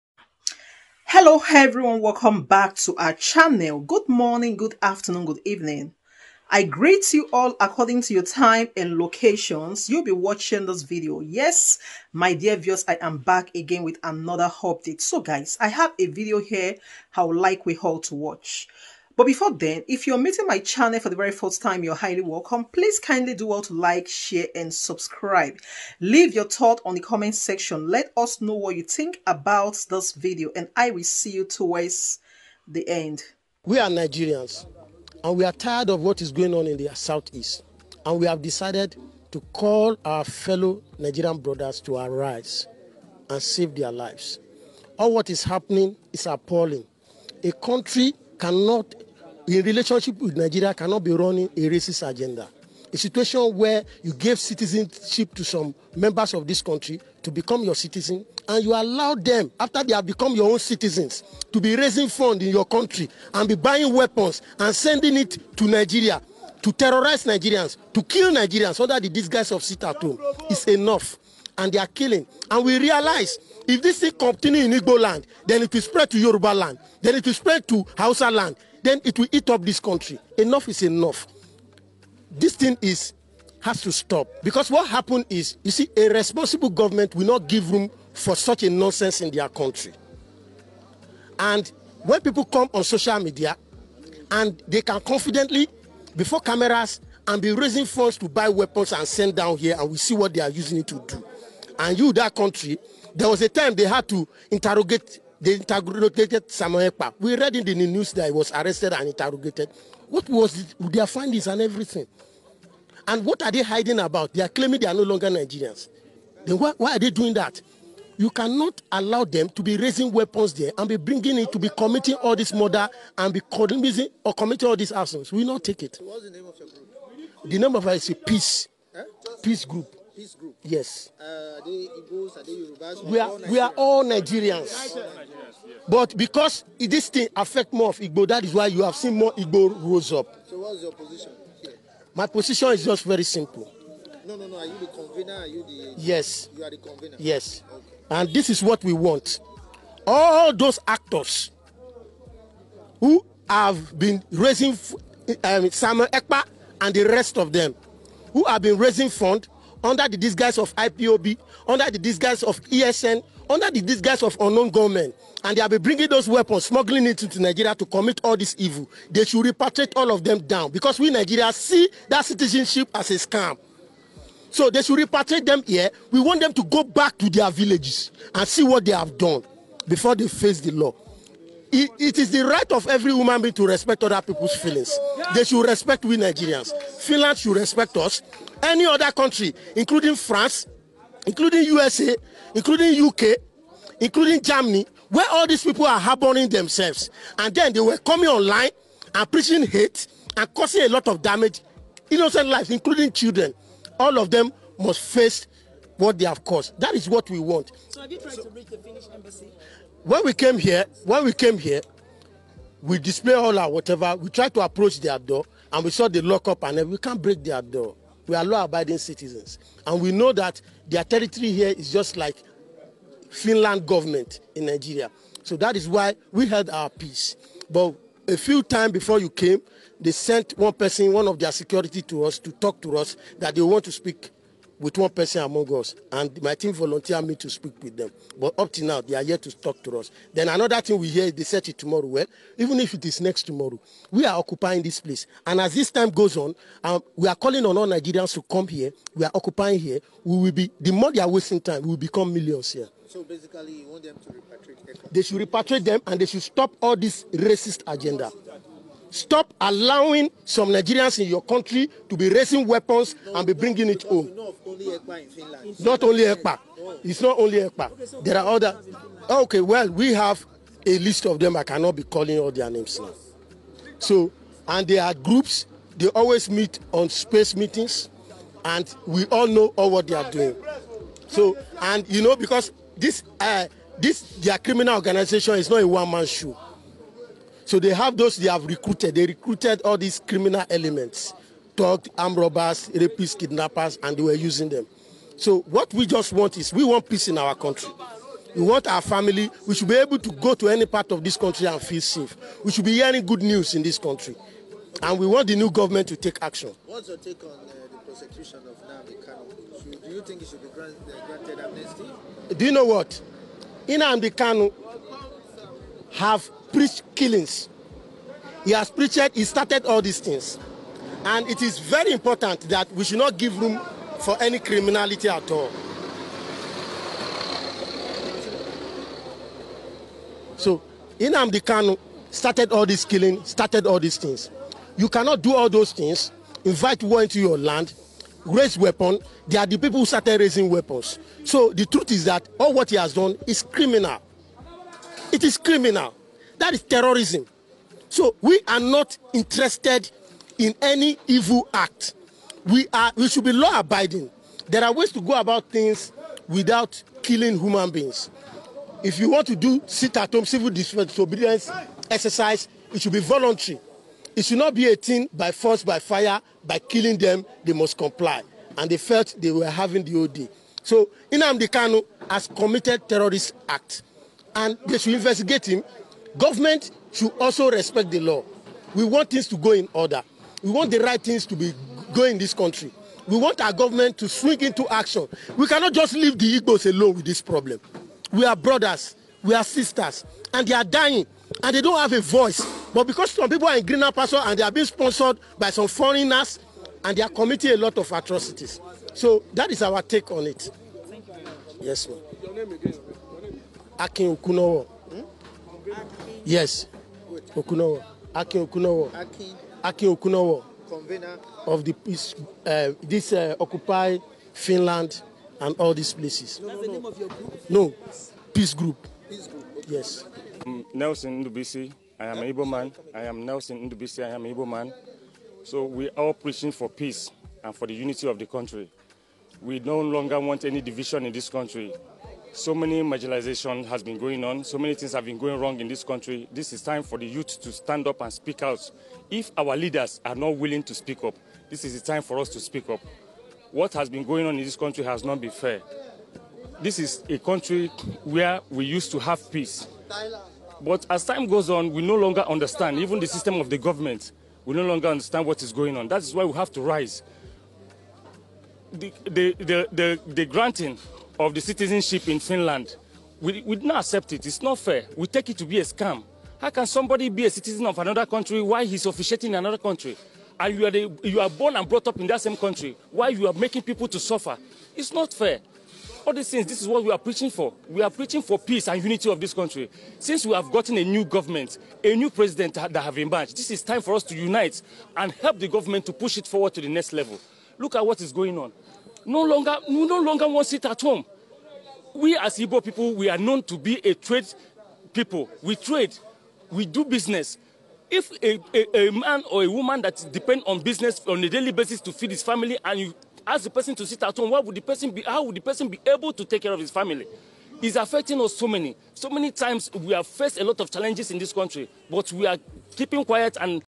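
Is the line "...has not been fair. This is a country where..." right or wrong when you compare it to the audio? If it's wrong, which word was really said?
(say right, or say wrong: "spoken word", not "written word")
right.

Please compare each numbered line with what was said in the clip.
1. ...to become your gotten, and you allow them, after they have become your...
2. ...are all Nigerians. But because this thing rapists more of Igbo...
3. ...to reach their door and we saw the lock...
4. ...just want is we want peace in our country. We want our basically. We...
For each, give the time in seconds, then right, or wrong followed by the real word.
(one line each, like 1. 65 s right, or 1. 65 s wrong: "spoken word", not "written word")
1. 57 s wrong: "citizen", not "gotten"
2. 133 s wrong: "affects", not "rapists"
3. 214 s wrong: "approach", not "reach"
4. 296 s wrong: "family", not "basically".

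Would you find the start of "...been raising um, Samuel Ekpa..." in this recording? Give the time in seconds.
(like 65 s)
153 s.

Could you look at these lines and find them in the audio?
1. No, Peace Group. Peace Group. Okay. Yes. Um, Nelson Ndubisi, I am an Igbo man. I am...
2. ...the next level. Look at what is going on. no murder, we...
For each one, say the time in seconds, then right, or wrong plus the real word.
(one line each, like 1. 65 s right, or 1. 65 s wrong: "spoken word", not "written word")
1. 417 s right
2. 486 s wrong: "longer", not "murder".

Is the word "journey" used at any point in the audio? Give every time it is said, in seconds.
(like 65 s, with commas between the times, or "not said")
not said.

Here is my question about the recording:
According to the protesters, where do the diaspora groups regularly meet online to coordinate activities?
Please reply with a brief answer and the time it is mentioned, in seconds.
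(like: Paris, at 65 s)
space meetings, at 277 s.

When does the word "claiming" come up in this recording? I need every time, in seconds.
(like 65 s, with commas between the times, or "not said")
114 s.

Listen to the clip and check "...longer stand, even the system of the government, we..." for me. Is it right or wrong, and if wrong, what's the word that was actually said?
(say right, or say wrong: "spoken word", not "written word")
wrong: "understand", not "stand".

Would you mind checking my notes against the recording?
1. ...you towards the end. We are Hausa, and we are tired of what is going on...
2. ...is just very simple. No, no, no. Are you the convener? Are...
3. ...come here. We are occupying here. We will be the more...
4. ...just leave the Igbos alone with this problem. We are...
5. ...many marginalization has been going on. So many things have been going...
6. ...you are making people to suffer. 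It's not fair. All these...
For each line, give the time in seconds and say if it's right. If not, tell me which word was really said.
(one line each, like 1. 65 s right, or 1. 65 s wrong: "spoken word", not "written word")
1. 31 s wrong: "Nigerians", not "Hausa"
2. 142 s right
3. 248 s right
4. 385 s right
5. 432 s right
6. 473 s right.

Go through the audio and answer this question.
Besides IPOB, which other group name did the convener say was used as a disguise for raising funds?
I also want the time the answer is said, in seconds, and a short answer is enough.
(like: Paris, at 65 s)
ESN, at 162 s.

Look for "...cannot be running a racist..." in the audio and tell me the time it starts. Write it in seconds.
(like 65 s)
50 s.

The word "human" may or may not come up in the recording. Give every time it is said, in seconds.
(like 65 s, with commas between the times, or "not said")
183 s, 357 s.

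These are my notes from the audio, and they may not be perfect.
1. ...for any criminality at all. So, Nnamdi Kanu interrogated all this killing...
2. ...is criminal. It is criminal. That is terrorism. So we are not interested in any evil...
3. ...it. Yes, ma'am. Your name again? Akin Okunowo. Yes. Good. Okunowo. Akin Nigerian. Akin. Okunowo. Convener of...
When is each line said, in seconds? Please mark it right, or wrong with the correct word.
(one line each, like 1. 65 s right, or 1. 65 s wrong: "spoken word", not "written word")
1. 324 s wrong: "started", not "interrogated"
2. 343 s right
3. 400 s wrong: "Okunowo", not "Nigerian".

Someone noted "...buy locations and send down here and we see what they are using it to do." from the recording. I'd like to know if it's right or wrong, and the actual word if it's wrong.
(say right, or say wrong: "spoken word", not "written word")
wrong: "weapons", not "locations".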